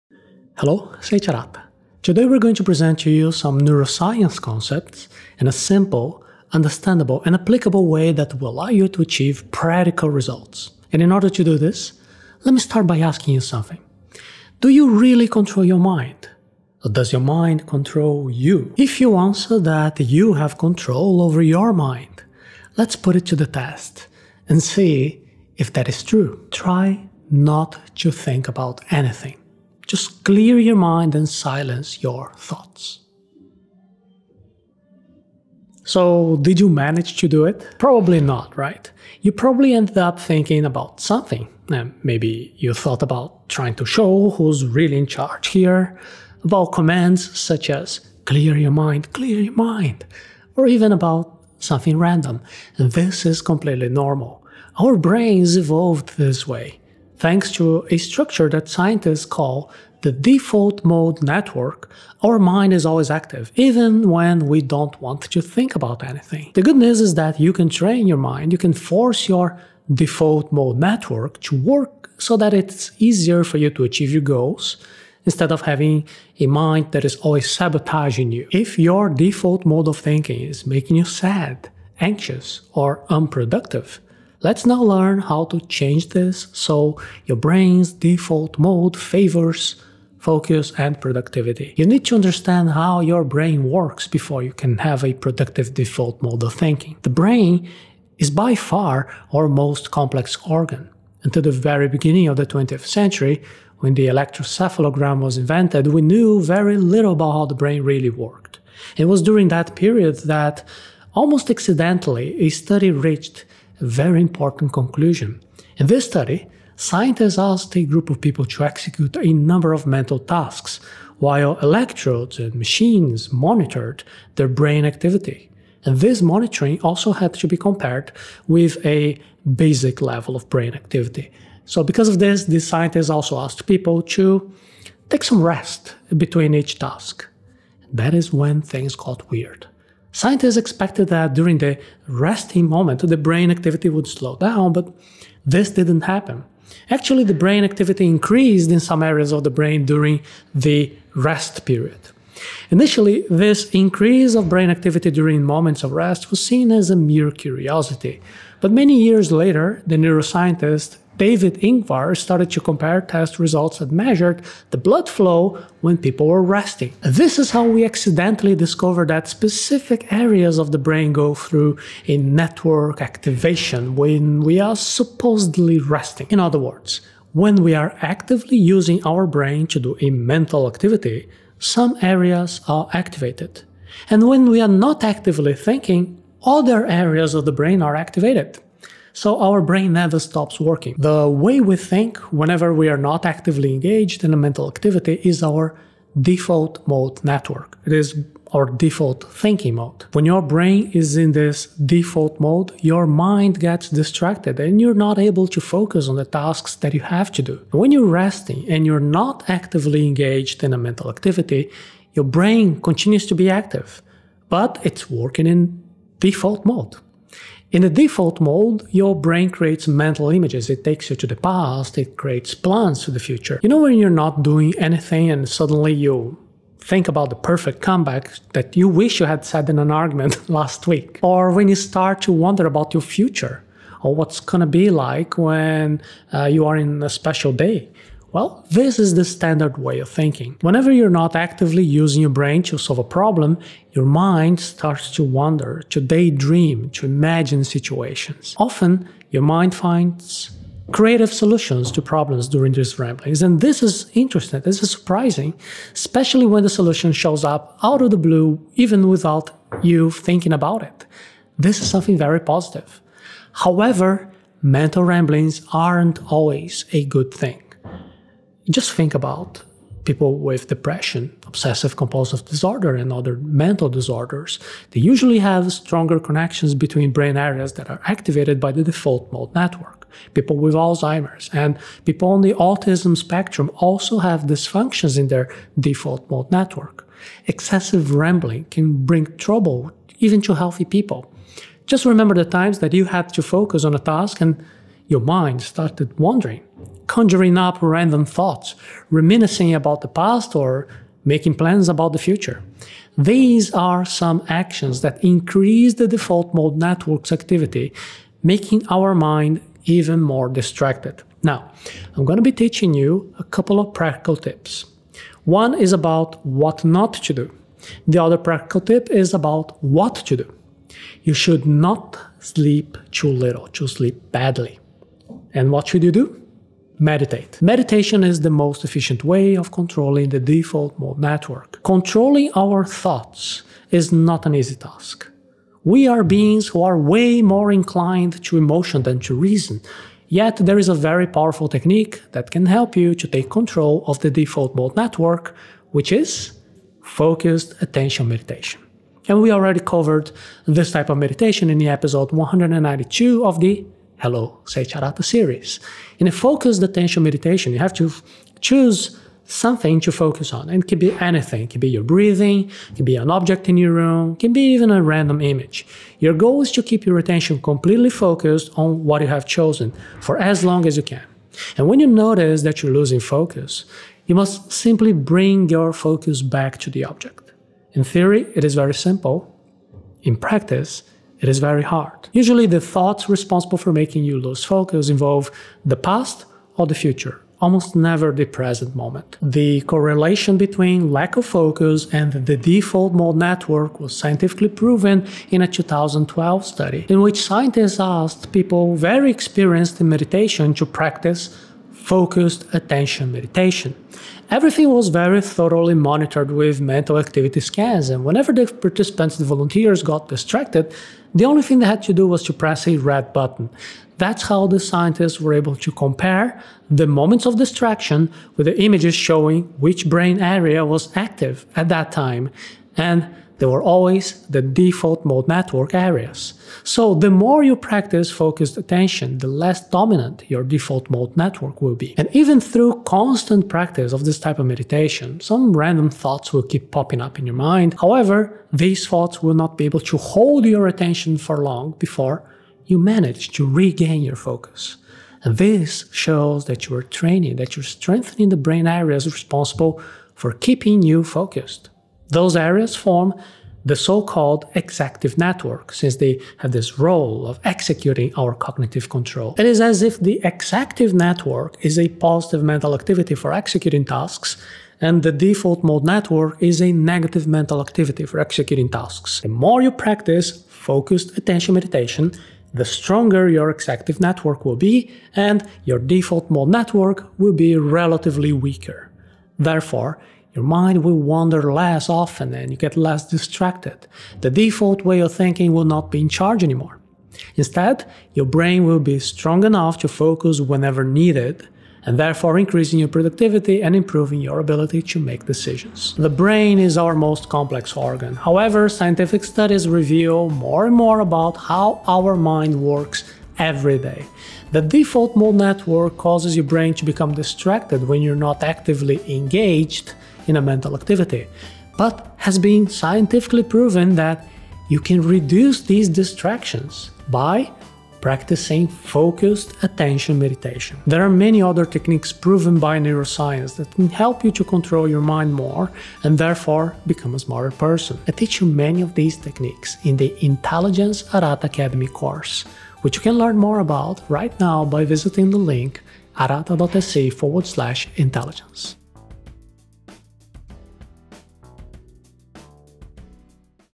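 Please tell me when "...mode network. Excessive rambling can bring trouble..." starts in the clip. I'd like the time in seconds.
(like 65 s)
286 s.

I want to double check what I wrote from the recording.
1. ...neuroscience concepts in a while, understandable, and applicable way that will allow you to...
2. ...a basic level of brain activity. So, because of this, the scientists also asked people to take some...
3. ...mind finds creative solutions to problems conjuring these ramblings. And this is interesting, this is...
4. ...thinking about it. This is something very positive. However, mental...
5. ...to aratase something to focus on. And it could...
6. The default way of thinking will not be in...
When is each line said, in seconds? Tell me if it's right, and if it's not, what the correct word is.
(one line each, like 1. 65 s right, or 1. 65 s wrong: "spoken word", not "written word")
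1. 3 s wrong: "simple", not "while"
2. 128 s right
3. 249 s wrong: "during", not "conjuring"
4. 260 s right
5. 357 s wrong: "choose", not "aratase"
6. 484 s right.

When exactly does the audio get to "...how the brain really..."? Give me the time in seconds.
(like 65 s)
107 s.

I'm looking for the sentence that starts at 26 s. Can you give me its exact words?
Try not to think about anything.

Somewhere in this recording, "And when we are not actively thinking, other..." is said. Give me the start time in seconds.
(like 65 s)
184 s.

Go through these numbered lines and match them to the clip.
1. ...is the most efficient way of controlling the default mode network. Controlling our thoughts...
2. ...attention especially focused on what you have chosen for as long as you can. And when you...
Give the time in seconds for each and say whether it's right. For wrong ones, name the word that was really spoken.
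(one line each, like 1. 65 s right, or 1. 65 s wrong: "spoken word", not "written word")
1. 328 s right
2. 367 s wrong: "completely", not "especially".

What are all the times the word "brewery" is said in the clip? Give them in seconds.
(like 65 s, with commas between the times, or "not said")
not said.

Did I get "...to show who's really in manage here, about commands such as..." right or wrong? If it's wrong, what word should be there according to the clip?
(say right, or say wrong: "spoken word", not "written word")
wrong: "charge", not "manage".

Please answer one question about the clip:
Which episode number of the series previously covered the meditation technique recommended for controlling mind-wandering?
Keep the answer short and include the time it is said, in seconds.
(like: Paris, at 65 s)
192, at 352 s.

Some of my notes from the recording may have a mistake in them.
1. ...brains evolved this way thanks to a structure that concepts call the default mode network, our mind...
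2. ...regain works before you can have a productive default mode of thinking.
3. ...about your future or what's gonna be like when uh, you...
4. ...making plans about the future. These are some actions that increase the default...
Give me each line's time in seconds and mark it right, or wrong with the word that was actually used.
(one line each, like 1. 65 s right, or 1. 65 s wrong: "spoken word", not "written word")
1. 54 s wrong: "scientists", not "concepts"
2. 93 s wrong: "brain", not "regain"
3. 232 s right
4. 301 s right.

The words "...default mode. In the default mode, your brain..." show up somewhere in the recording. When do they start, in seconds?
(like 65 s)
216 s.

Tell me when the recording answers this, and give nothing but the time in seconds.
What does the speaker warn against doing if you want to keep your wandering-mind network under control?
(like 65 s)
322 s.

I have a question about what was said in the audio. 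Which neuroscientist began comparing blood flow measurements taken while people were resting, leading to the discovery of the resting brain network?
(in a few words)
David Ingvar.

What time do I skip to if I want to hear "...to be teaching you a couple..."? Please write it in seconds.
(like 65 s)
312 s.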